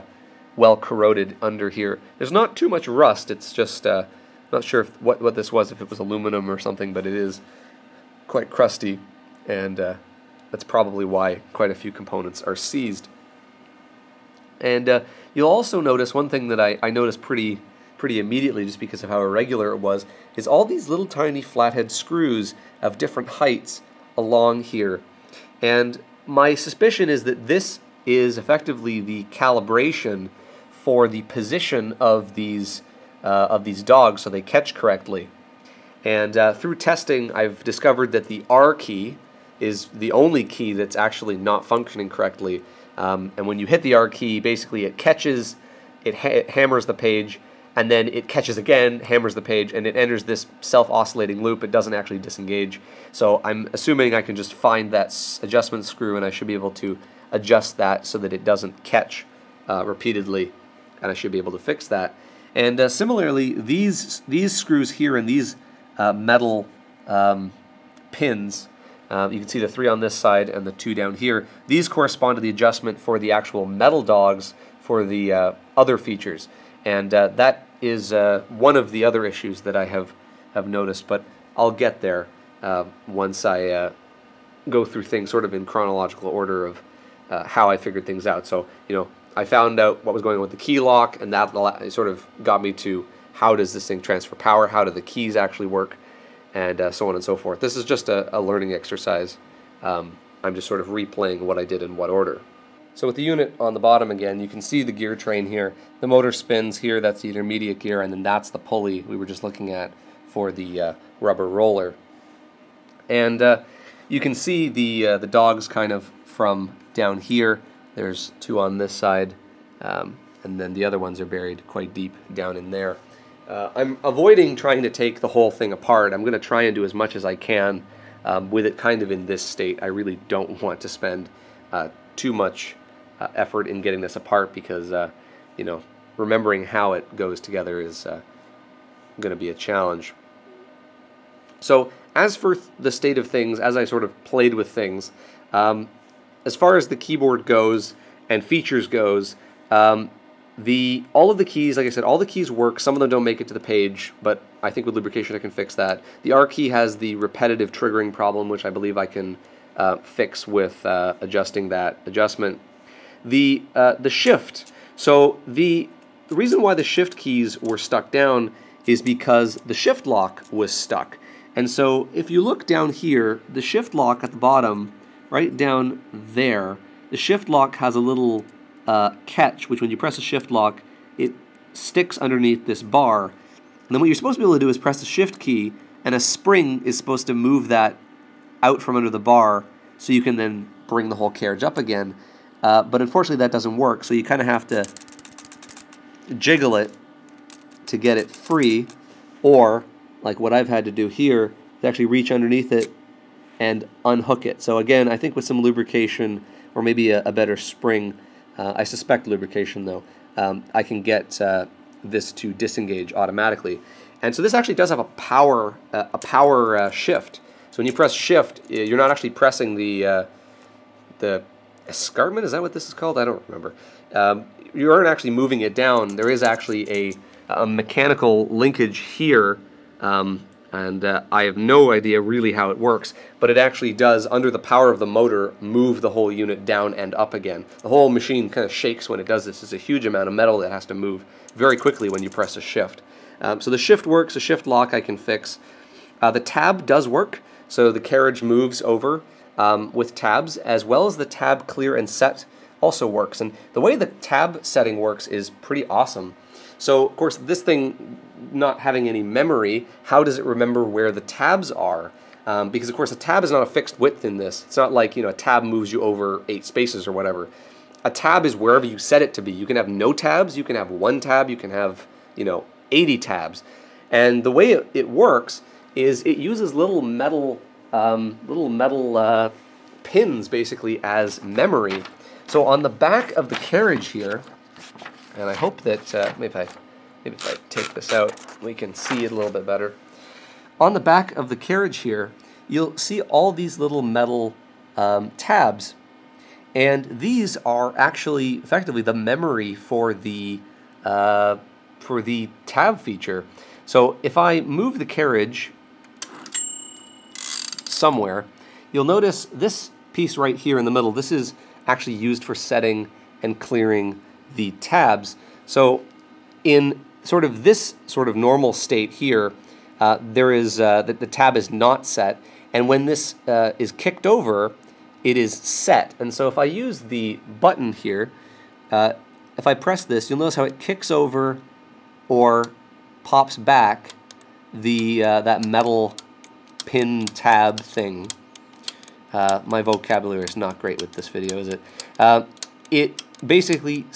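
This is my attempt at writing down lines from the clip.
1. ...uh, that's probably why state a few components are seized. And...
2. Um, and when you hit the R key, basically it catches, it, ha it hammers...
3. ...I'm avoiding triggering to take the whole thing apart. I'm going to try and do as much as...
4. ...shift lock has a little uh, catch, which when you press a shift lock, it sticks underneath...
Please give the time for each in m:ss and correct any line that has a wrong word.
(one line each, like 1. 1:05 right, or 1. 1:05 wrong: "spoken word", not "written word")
1. 0:09 wrong: "quite", not "state"
2. 0:42 right
3. 2:03 wrong: "trying", not "triggering"
4. 2:57 right.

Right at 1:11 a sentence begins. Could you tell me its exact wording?
These correspond to the adjustment for the actual metal dogs for the uh, other features.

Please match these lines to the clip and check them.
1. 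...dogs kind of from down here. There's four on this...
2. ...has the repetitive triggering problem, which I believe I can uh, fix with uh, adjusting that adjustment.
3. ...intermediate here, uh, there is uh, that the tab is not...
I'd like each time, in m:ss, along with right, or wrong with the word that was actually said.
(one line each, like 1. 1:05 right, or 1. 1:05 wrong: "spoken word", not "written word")
1. 1:55 wrong: "two", not "four"
2. 2:36 right
3. 5:18 wrong: "state", not "intermediate".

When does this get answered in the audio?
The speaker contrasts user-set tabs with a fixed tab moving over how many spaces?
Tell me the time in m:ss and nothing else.
4:26.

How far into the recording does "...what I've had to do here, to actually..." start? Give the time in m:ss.
3:20.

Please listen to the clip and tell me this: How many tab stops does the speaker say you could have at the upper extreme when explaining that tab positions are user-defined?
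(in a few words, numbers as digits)
80.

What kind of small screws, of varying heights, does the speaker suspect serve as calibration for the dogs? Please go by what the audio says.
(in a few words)
flathead screws.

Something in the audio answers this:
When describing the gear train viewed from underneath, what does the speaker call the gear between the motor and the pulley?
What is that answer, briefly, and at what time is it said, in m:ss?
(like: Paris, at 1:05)
intermediate gear, at 1:47.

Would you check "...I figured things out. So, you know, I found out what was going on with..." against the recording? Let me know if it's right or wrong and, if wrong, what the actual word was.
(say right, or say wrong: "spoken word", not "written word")
right.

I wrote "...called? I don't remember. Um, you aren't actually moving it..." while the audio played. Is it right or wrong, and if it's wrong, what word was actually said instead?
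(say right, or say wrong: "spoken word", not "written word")
right.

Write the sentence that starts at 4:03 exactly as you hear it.
Um, so the shift works, the shift lock I can fix.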